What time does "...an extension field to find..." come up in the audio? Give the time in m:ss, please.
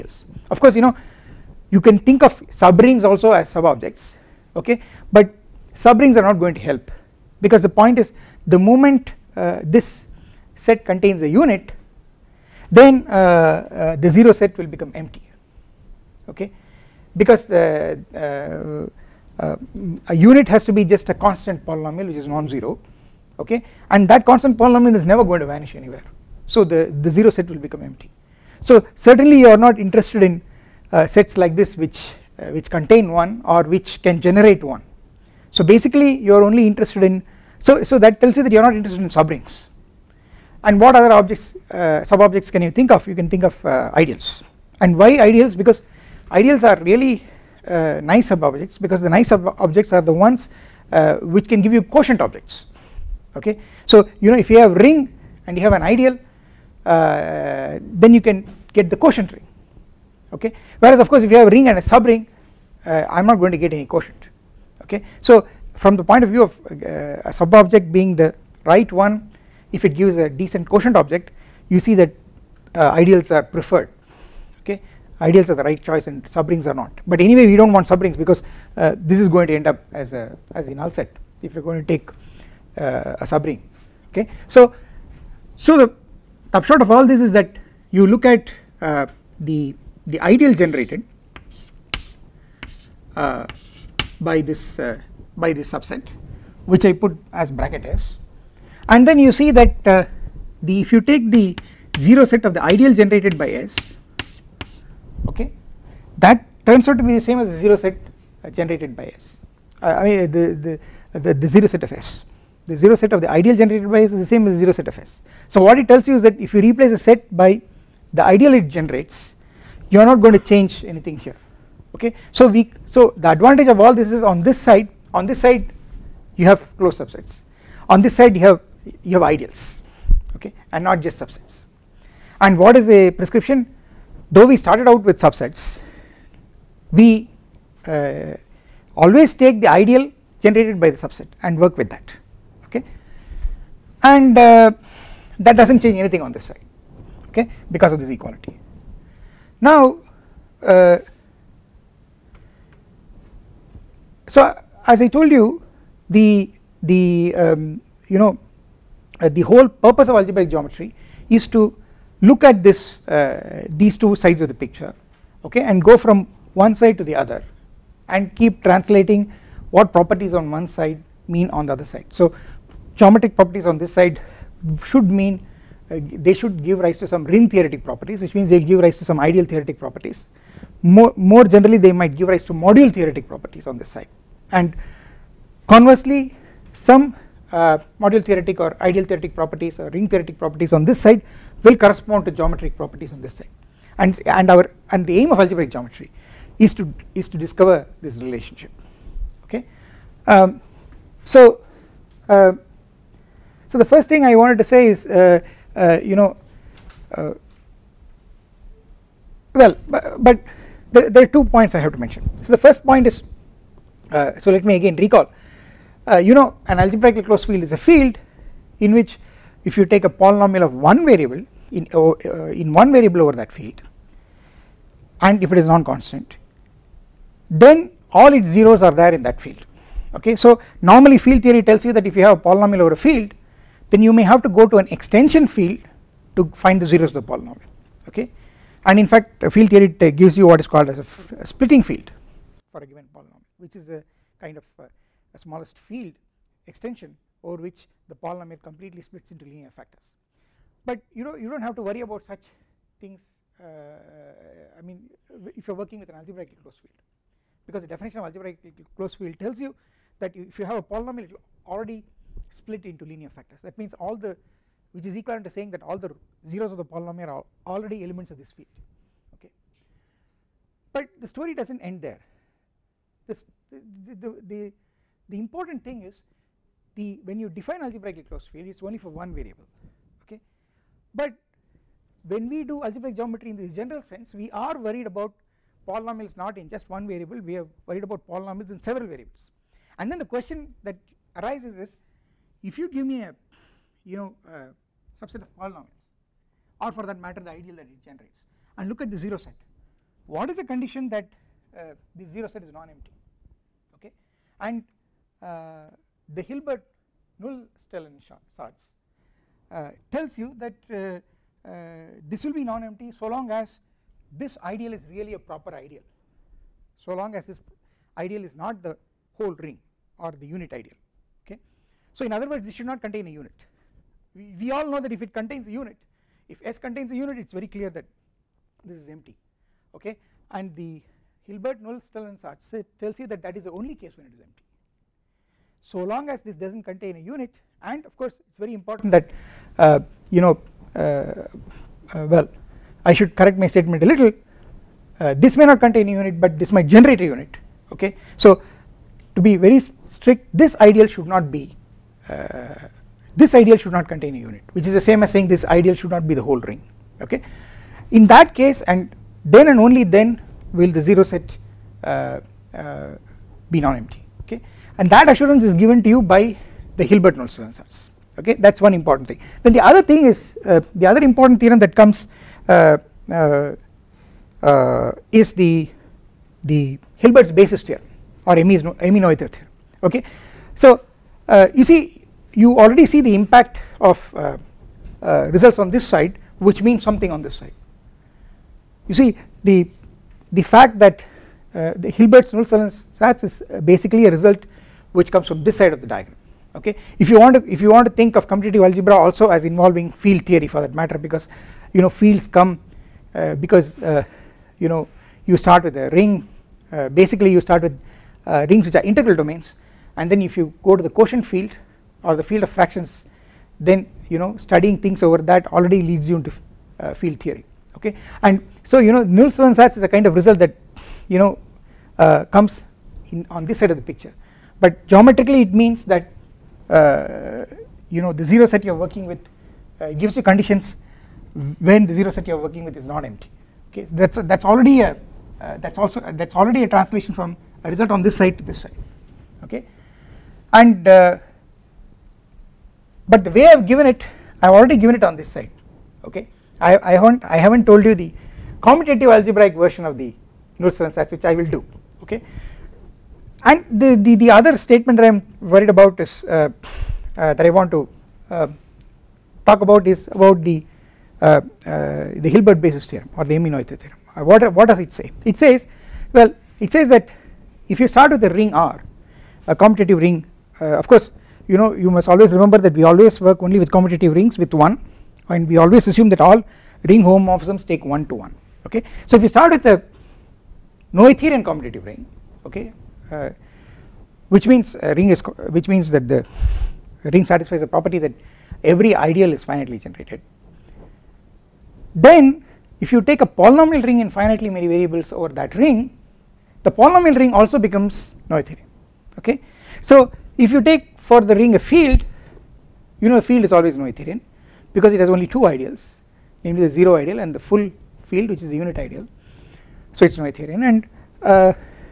3:54.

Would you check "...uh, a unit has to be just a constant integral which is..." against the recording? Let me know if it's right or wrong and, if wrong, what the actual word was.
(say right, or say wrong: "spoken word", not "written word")
wrong: "polynomial", not "integral".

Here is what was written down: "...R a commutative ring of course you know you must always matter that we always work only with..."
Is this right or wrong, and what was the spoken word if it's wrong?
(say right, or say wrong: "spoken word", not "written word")
wrong: "remember", not "matter".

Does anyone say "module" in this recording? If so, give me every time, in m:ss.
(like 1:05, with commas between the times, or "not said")
3:02, 3:07.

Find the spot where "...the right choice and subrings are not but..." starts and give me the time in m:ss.
1:15.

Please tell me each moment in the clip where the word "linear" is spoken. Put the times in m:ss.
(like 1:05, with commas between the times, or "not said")
4:09, 4:23.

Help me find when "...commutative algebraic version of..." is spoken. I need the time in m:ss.
7:28.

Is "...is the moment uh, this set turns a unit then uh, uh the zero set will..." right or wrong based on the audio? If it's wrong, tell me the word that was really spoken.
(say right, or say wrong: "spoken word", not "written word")
wrong: "contains", not "turns".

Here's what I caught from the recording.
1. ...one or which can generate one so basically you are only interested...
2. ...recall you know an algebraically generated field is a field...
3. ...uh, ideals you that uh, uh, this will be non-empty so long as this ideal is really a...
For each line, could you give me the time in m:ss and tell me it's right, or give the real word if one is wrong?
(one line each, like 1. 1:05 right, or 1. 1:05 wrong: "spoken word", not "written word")
1. 0:33 right
2. 3:34 wrong: "closed", not "generated"
3. 5:09 wrong: "tells", not "ideals".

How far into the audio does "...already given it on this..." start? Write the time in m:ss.
7:24.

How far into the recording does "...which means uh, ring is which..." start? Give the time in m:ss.
8:04.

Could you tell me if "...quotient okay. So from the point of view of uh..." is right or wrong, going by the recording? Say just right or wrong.
right.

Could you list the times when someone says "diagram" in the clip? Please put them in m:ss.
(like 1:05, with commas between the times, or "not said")
6:36.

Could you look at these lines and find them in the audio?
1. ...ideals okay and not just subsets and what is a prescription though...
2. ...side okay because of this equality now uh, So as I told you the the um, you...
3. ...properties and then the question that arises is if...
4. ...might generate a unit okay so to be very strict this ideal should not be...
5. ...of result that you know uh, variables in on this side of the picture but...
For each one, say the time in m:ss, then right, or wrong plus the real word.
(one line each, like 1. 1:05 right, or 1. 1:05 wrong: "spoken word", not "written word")
1. 2:09 right
2. 2:26 right
3. 4:49 wrong: "variables", not "properties"
4. 5:46 right
5. 7:00 wrong: "comes", not "variables".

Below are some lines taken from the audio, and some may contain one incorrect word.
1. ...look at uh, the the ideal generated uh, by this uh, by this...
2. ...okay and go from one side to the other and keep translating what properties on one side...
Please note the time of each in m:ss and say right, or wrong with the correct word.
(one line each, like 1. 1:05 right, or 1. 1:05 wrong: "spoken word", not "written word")
1. 1:28 right
2. 2:45 right.